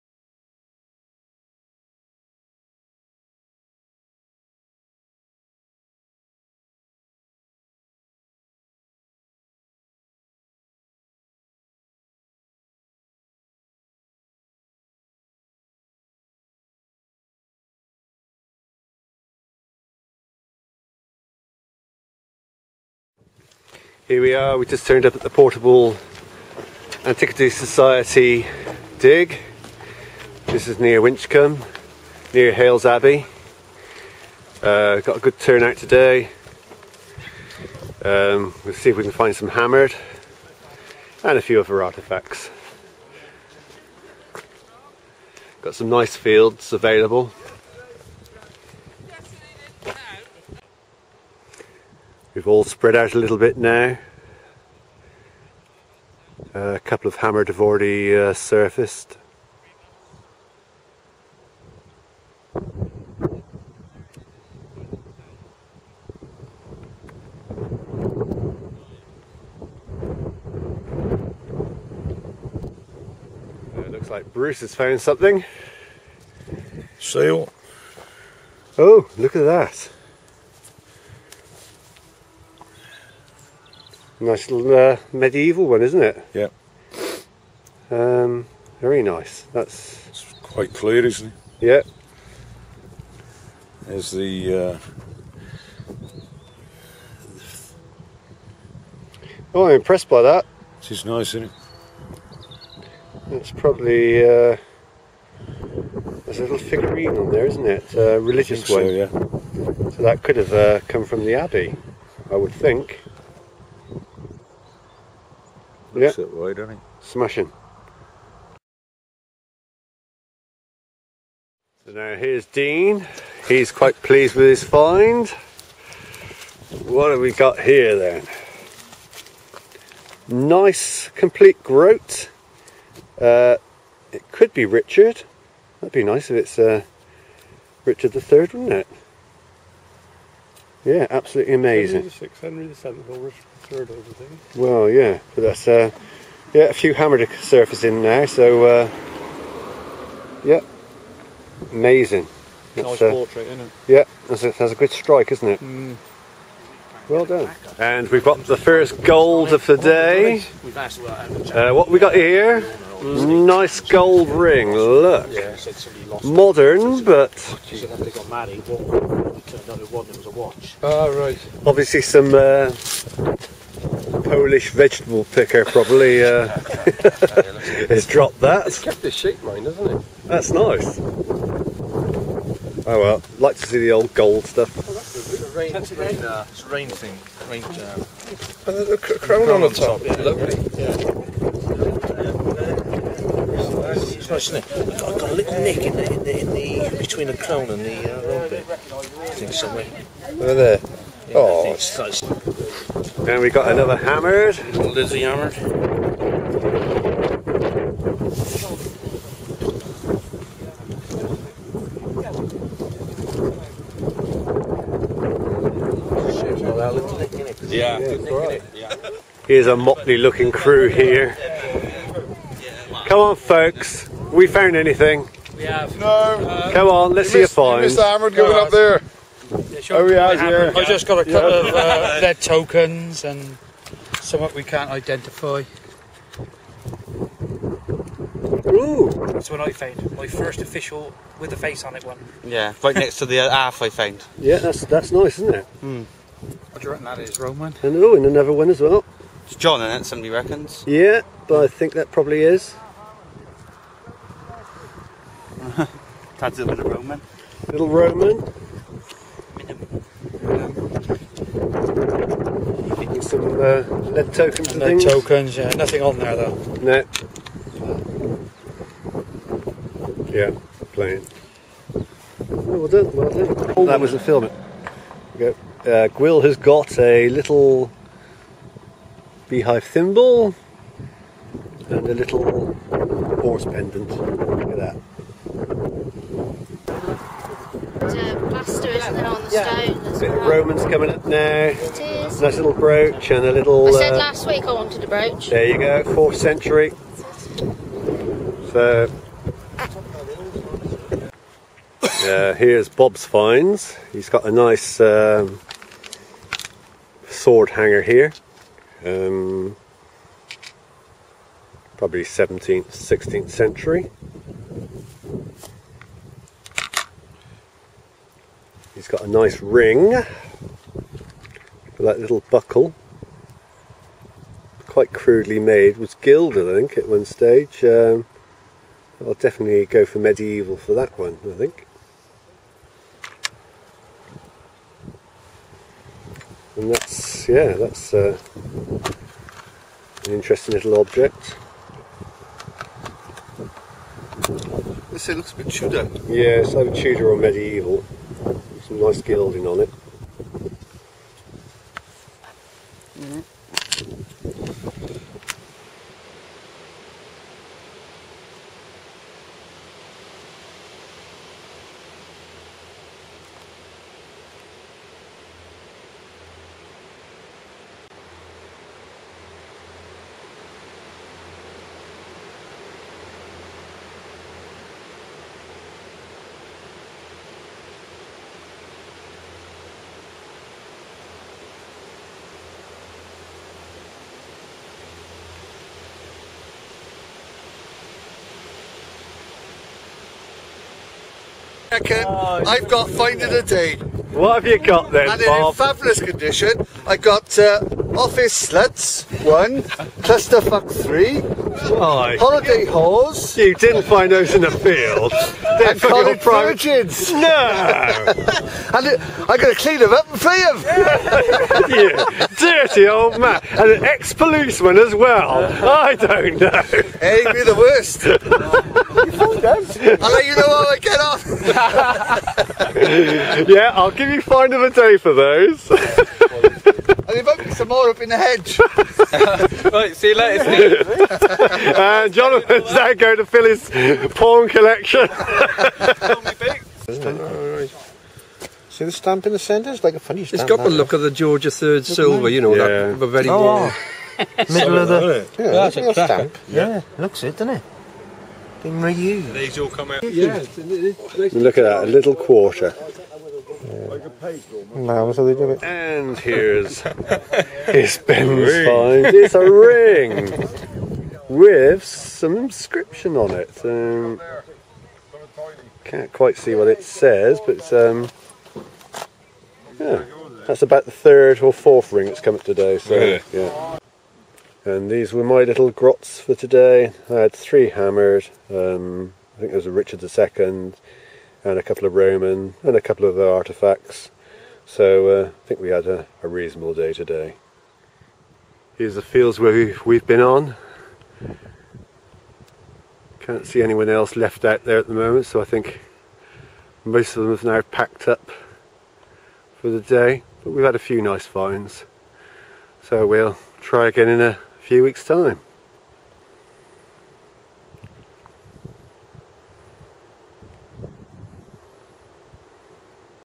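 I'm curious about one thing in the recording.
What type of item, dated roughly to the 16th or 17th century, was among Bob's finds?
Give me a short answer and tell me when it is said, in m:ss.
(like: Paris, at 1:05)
Sword hanger, at 5:07.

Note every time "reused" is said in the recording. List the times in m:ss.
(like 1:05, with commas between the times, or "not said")
7:29.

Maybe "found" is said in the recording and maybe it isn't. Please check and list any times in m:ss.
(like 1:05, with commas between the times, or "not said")
1:14, 3:44, 3:59, 4:03.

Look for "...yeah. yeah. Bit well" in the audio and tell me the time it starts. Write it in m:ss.
4:48.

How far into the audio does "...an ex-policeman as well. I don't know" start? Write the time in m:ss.
6:53.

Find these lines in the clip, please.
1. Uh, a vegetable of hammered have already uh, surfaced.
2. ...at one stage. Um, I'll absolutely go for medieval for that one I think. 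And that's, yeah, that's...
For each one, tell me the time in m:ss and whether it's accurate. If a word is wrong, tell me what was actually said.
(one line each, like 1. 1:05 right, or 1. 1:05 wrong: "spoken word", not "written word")
1. 0:56 wrong: "couple", not "vegetable"
2. 5:26 wrong: "definitely", not "absolutely".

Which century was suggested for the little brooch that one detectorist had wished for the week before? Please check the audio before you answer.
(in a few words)
4th century.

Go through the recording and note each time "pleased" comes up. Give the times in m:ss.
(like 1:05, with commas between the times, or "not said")
2:04.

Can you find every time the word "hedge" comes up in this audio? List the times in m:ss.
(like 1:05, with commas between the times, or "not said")
7:08.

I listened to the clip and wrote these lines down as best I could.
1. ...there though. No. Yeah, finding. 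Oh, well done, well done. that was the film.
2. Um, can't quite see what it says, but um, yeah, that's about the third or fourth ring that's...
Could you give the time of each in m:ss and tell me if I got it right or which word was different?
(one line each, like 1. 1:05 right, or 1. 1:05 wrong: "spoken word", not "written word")
1. 4:26 wrong: "playing", not "finding"
2. 7:43 right.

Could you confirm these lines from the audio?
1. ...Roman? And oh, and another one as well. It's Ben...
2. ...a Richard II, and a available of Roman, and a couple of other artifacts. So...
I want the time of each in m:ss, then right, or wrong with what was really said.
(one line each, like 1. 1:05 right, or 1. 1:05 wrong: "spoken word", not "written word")
1. 4:07 wrong: "John", not "Ben"
2. 7:59 wrong: "couple", not "available".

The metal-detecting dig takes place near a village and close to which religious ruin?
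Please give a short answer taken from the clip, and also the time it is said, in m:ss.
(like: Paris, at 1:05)
Hailes Abbey, at 0:32.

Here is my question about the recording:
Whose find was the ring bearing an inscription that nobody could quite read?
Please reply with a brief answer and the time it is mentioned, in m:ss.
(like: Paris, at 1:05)
Ben, at 7:38.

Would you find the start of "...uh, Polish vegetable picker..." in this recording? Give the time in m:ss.
2:52.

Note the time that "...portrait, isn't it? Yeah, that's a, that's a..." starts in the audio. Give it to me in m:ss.
2:33.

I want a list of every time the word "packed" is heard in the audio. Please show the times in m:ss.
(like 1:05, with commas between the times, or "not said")
8:17.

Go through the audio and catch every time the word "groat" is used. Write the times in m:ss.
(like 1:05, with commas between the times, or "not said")
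2:11.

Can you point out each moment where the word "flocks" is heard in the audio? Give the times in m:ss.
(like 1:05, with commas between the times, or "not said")
not said.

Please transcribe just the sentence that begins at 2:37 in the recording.
And we've got the first gold of the day.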